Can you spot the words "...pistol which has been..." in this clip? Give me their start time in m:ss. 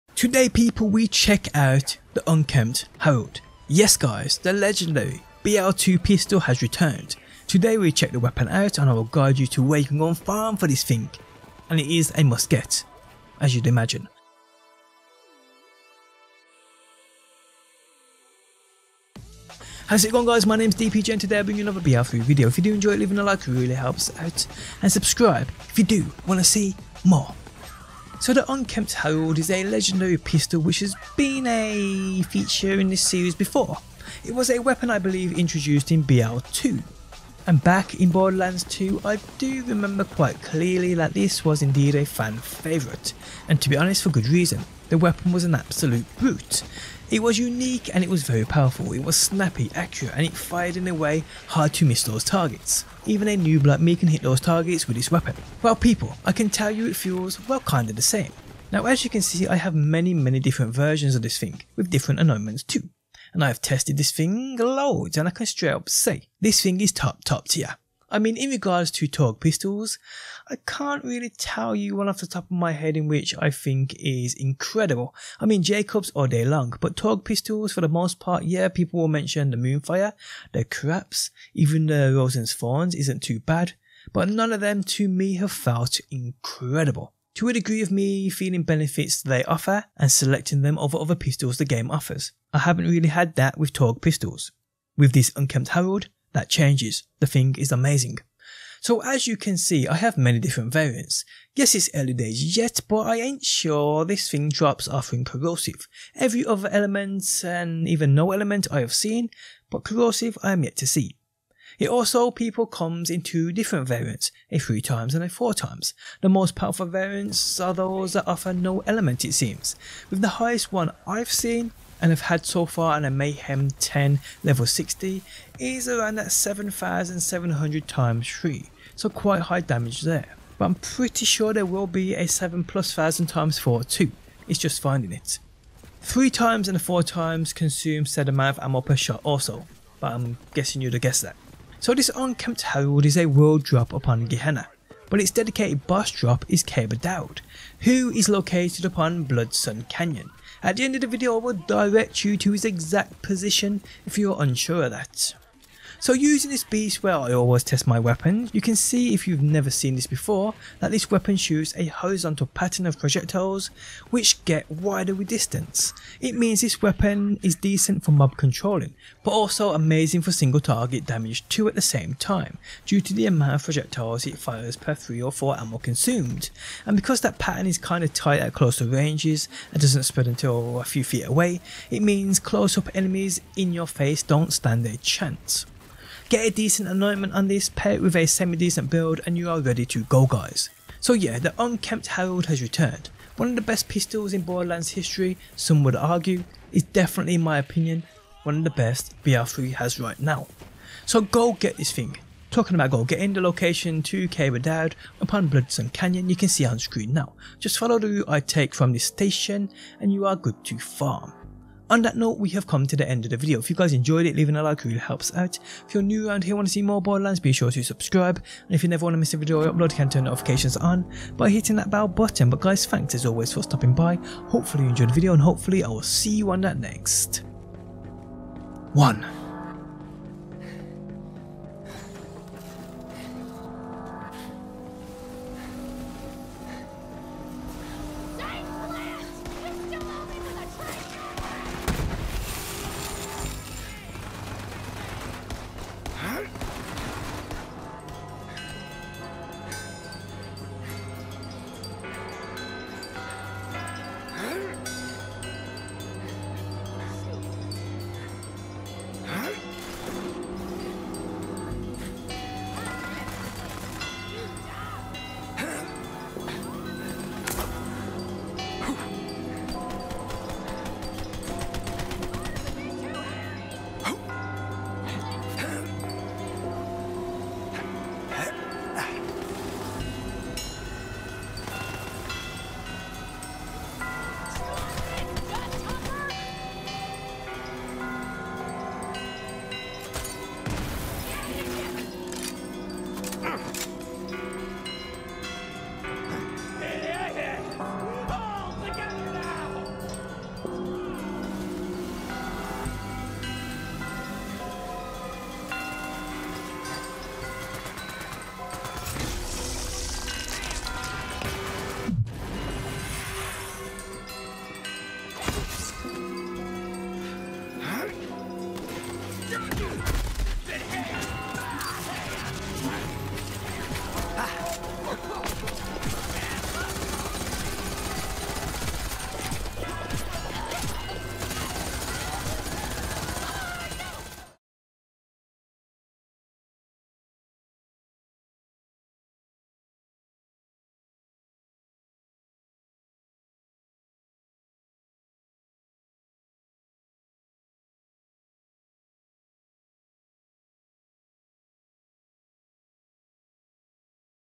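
0:30.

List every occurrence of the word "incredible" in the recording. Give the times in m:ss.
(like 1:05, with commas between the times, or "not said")
1:14, 1:26.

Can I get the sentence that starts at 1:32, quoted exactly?
I haven't really had that with Torgue pistols.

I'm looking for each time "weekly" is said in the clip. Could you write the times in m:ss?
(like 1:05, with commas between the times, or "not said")
not said.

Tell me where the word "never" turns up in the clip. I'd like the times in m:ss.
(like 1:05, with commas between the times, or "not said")
2:39, 3:38.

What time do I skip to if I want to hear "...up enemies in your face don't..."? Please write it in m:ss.
3:02.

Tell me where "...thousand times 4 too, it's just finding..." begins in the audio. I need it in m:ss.
2:12.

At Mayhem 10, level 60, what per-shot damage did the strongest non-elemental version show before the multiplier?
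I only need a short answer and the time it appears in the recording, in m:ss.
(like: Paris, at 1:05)
7700, at 2:06.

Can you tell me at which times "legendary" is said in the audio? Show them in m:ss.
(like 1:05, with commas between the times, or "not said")
0:04, 0:29.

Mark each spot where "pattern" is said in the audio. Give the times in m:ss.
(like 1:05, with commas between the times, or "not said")
2:42, 2:57.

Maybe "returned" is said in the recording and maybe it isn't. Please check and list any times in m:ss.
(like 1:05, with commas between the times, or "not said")
0:06, 3:12.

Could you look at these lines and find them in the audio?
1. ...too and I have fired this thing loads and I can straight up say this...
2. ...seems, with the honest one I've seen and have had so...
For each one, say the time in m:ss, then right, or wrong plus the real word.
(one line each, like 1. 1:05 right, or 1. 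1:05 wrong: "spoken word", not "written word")
1. 1:02 wrong: "tested", not "fired"
2. 1:59 wrong: "highest", not "honest".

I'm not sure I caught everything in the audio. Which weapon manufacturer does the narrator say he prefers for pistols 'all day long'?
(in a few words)
Jacobs.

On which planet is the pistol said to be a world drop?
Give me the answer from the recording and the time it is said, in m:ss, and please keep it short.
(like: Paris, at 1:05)
Gehenna, at 2:24.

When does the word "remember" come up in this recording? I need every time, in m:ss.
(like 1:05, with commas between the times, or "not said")
0:39.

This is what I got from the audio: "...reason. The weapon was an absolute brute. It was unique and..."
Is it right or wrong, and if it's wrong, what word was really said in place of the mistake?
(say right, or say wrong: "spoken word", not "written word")
right.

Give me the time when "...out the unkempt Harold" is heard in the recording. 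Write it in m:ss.
0:01.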